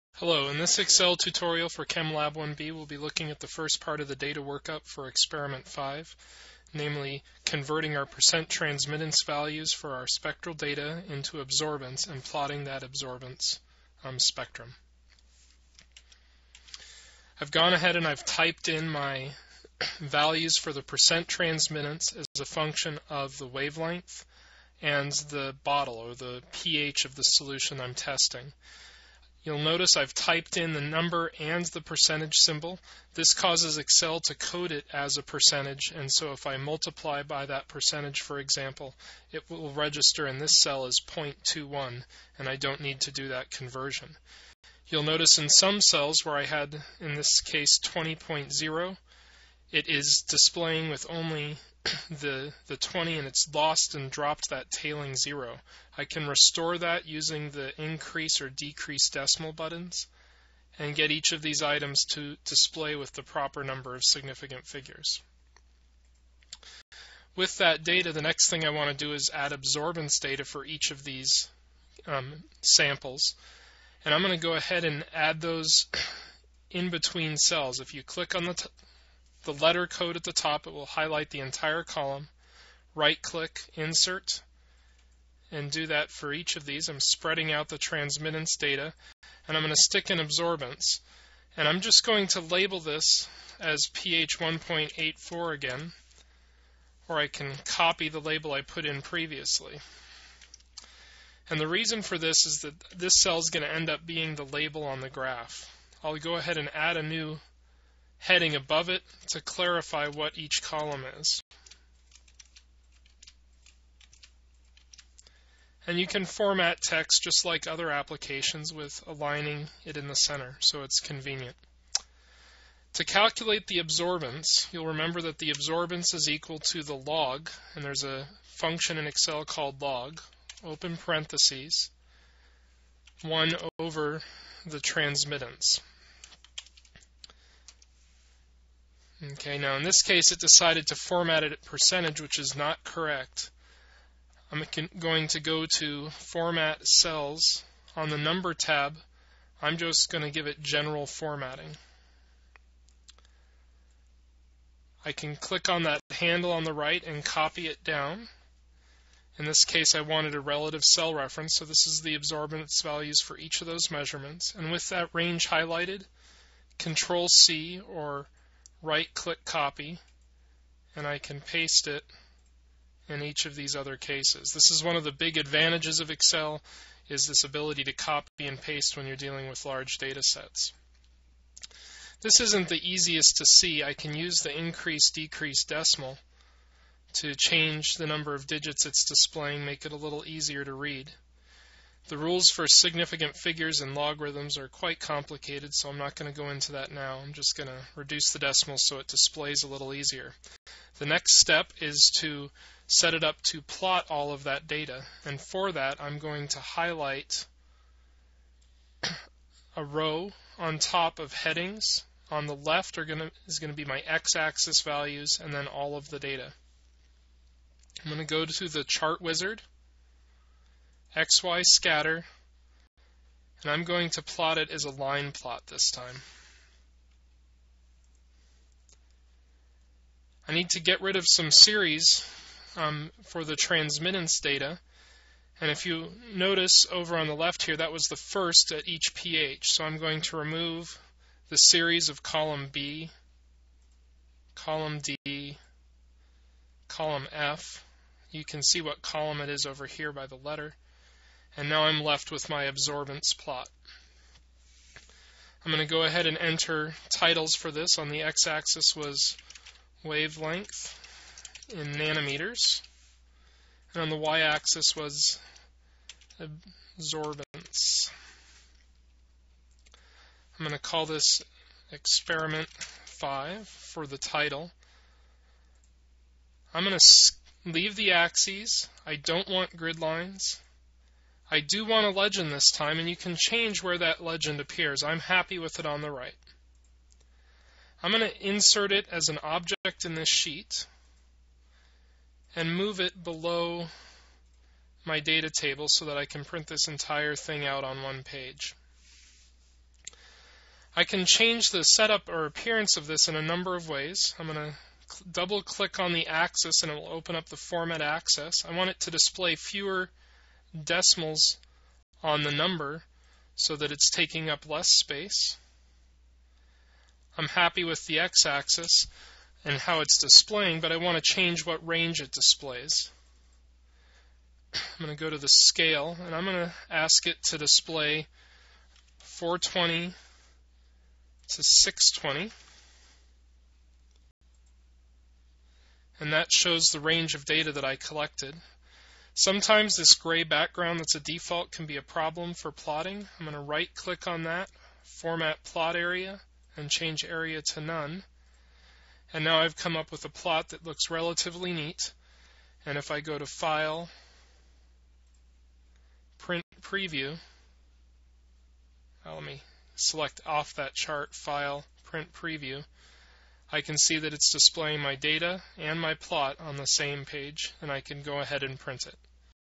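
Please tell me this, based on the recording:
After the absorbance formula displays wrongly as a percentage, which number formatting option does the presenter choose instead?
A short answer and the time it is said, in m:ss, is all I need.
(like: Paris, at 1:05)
General, at 2:30.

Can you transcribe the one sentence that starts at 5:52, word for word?
And if I go to File, Print Preview, now uh, let me select off that chart, File, Print Preview.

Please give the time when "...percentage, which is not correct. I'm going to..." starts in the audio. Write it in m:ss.
2:21.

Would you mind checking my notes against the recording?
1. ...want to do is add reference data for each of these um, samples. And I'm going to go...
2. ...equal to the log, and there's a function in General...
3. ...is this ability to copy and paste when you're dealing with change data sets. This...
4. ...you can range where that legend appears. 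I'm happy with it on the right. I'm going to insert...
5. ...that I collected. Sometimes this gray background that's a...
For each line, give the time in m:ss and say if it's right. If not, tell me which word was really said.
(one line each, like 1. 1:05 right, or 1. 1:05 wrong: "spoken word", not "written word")
1. 1:08 wrong: "absorbance", not "reference"
2. 2:06 wrong: "Excel", not "General"
3. 2:57 wrong: "large", not "change"
4. 4:43 wrong: "change", not "range"
5. 5:37 right.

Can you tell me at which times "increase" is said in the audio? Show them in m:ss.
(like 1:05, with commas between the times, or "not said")
0:57, 3:04.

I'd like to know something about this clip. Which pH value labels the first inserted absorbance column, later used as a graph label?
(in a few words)
1.84.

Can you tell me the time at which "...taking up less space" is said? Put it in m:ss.
5:14.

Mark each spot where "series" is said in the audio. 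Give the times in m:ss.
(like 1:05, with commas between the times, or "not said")
3:51, 4:01.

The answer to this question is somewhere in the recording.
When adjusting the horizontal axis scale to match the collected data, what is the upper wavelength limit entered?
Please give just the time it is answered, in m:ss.
5:31.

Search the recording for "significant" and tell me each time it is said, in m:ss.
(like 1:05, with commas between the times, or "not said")
1:04, 3:12.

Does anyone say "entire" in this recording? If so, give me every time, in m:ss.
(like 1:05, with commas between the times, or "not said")
1:21, 4:56.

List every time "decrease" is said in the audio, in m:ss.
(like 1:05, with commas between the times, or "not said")
0:58, 3:05.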